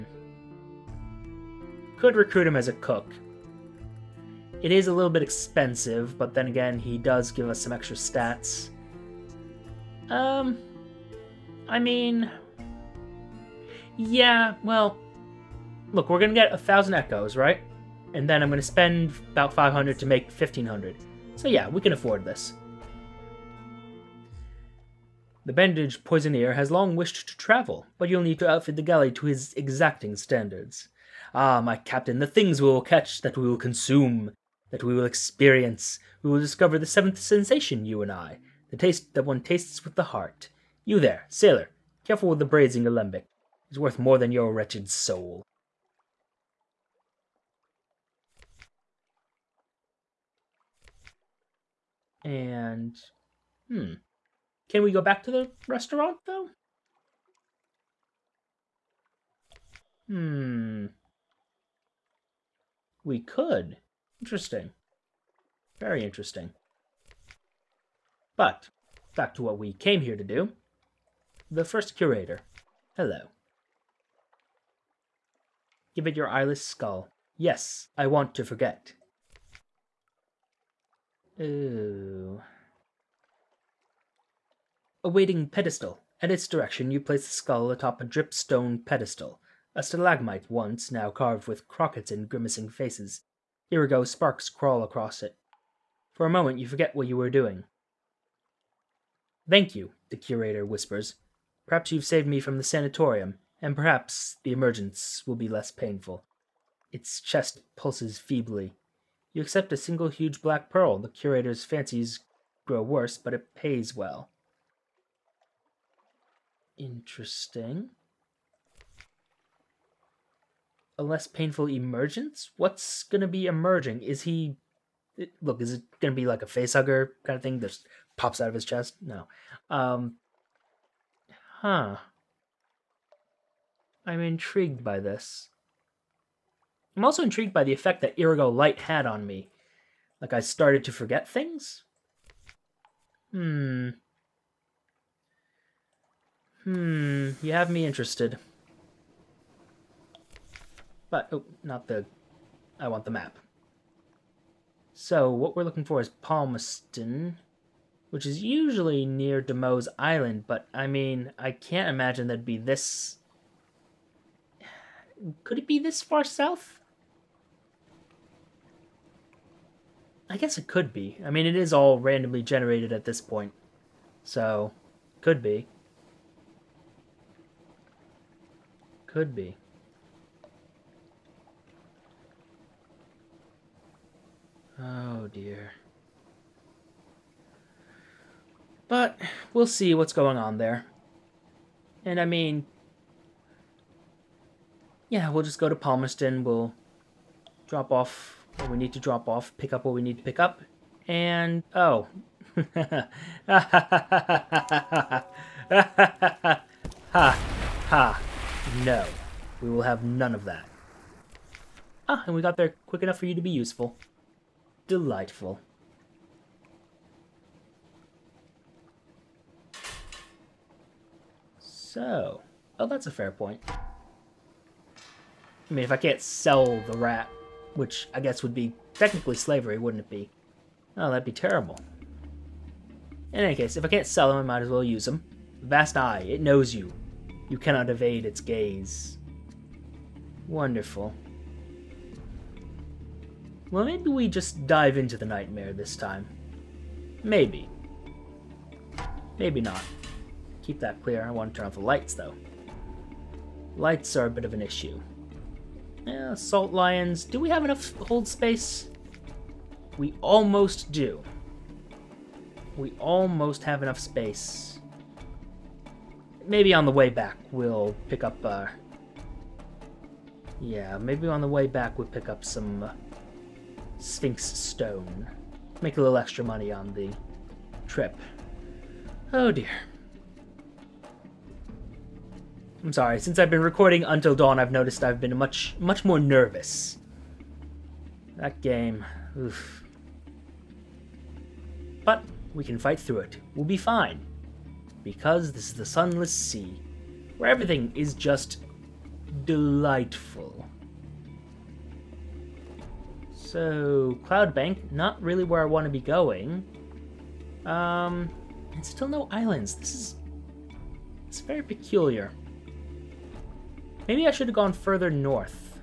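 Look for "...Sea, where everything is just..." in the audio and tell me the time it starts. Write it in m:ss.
4:56.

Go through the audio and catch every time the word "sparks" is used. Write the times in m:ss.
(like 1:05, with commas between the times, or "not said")
1:34.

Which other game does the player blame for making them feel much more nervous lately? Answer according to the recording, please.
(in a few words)
Until Dawn.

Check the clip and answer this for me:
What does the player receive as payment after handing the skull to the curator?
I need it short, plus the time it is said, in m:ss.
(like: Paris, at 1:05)
huge black pearl, at 1:50.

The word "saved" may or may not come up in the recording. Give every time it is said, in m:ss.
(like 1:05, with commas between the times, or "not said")
1:42.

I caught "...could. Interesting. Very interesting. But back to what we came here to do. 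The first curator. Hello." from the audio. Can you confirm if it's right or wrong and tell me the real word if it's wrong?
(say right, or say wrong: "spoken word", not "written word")
right.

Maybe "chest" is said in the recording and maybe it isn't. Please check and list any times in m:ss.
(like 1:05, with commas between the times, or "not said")
1:47, 2:08.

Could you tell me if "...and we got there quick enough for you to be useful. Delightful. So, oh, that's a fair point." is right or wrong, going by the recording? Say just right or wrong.
right.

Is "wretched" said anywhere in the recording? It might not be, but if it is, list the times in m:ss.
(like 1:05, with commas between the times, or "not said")
0:44.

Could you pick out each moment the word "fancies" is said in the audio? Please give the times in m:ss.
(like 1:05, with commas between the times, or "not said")
1:51.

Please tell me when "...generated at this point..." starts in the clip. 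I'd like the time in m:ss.
2:52.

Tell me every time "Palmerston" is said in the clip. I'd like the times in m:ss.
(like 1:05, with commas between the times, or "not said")
2:36, 3:15.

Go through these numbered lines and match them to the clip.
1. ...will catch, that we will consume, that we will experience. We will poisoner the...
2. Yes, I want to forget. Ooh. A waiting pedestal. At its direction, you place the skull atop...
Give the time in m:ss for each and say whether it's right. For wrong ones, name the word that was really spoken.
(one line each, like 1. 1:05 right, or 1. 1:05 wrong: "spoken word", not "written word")
1. 0:32 wrong: "discover", not "poisoner"
2. 1:17 right.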